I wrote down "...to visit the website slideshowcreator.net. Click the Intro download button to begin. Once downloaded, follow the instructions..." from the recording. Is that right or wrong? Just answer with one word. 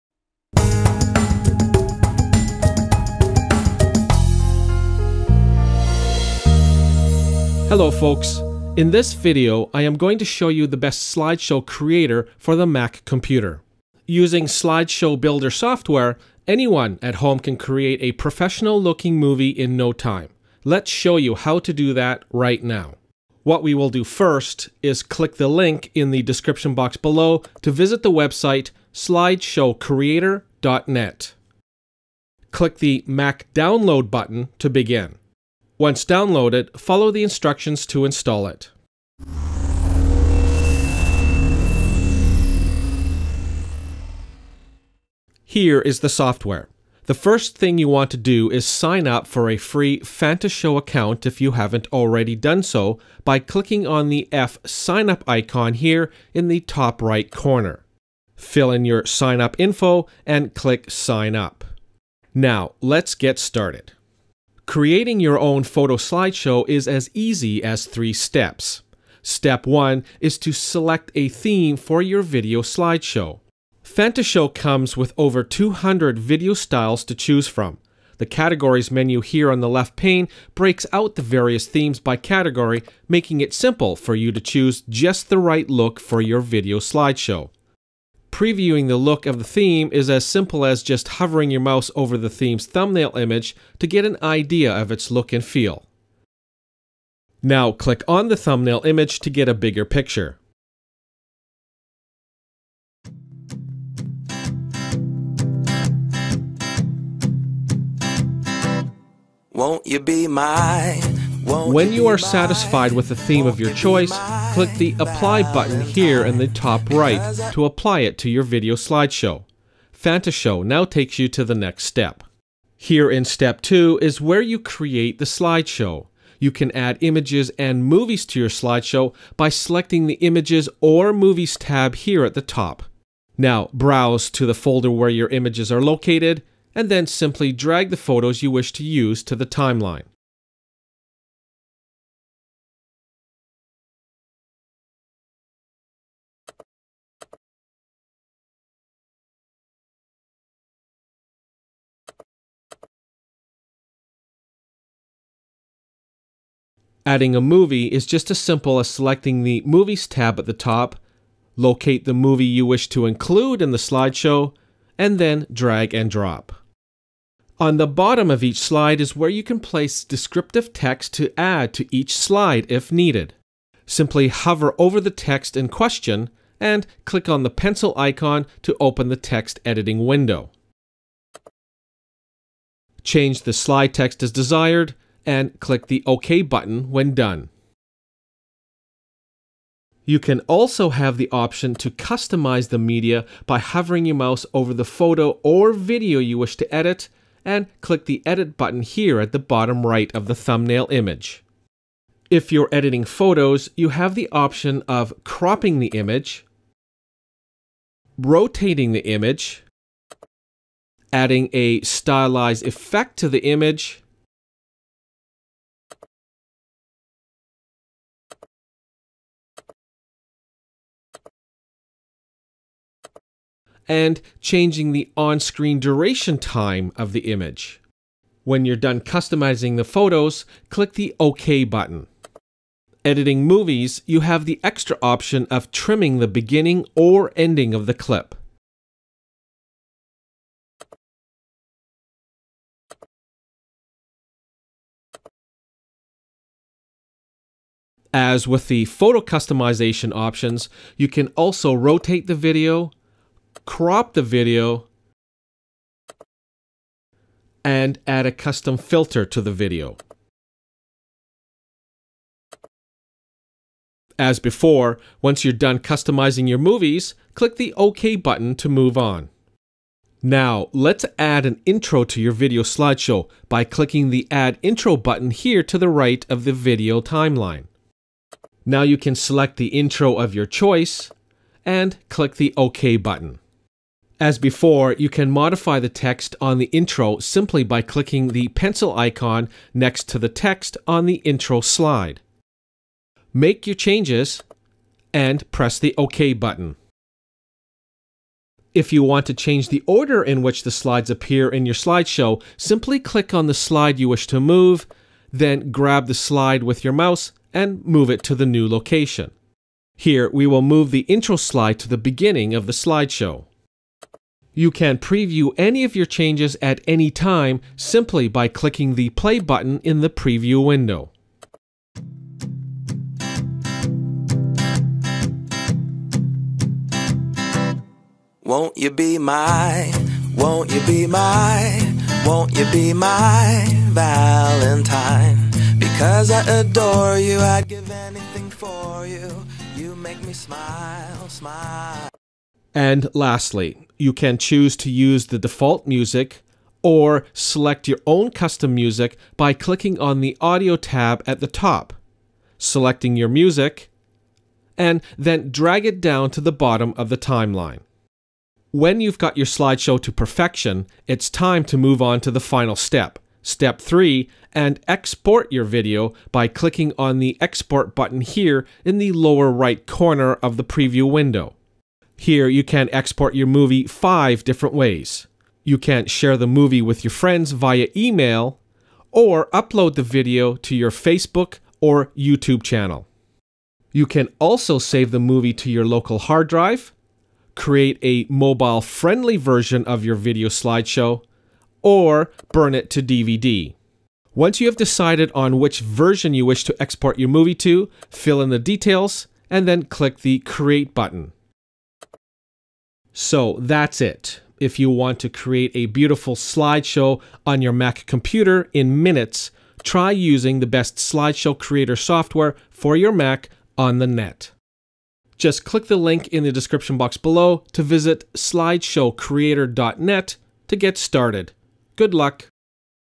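wrong.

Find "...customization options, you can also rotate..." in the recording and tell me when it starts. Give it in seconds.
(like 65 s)
249 s.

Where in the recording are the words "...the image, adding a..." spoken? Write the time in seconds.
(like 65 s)
208 s.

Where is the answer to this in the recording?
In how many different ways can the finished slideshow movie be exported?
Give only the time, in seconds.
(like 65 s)
373 s.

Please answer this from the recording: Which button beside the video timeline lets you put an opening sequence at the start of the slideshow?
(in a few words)
Add Intro.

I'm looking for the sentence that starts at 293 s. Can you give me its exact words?
Make your changes and press the OK button.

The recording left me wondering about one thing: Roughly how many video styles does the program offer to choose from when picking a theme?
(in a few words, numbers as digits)
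over 200.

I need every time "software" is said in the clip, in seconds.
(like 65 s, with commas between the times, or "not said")
15 s, 46 s, 411 s.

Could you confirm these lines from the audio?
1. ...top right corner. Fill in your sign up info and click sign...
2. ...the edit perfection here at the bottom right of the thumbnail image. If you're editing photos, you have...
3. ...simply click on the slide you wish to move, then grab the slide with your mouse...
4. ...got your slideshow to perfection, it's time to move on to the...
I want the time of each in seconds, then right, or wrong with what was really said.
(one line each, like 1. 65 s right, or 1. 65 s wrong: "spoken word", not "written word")
1. 56 s right
2. 198 s wrong: "button", not "perfection"
3. 302 s right
4. 359 s right.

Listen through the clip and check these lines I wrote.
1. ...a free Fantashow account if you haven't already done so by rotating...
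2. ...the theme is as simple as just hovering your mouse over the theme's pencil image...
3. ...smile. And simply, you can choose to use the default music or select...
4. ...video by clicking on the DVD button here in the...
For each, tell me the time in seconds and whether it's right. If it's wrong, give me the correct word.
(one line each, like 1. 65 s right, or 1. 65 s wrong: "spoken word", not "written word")
1. 49 s wrong: "clicking", not "rotating"
2. 89 s wrong: "thumbnail", not "pencil"
3. 341 s wrong: "lastly", not "simply"
4. 365 s wrong: "Export", not "DVD".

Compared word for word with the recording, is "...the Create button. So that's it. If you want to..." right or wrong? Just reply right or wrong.
right.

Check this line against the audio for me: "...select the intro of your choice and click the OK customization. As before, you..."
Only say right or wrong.
wrong.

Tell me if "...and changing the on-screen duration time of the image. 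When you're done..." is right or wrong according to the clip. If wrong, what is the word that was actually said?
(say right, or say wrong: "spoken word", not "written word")
right.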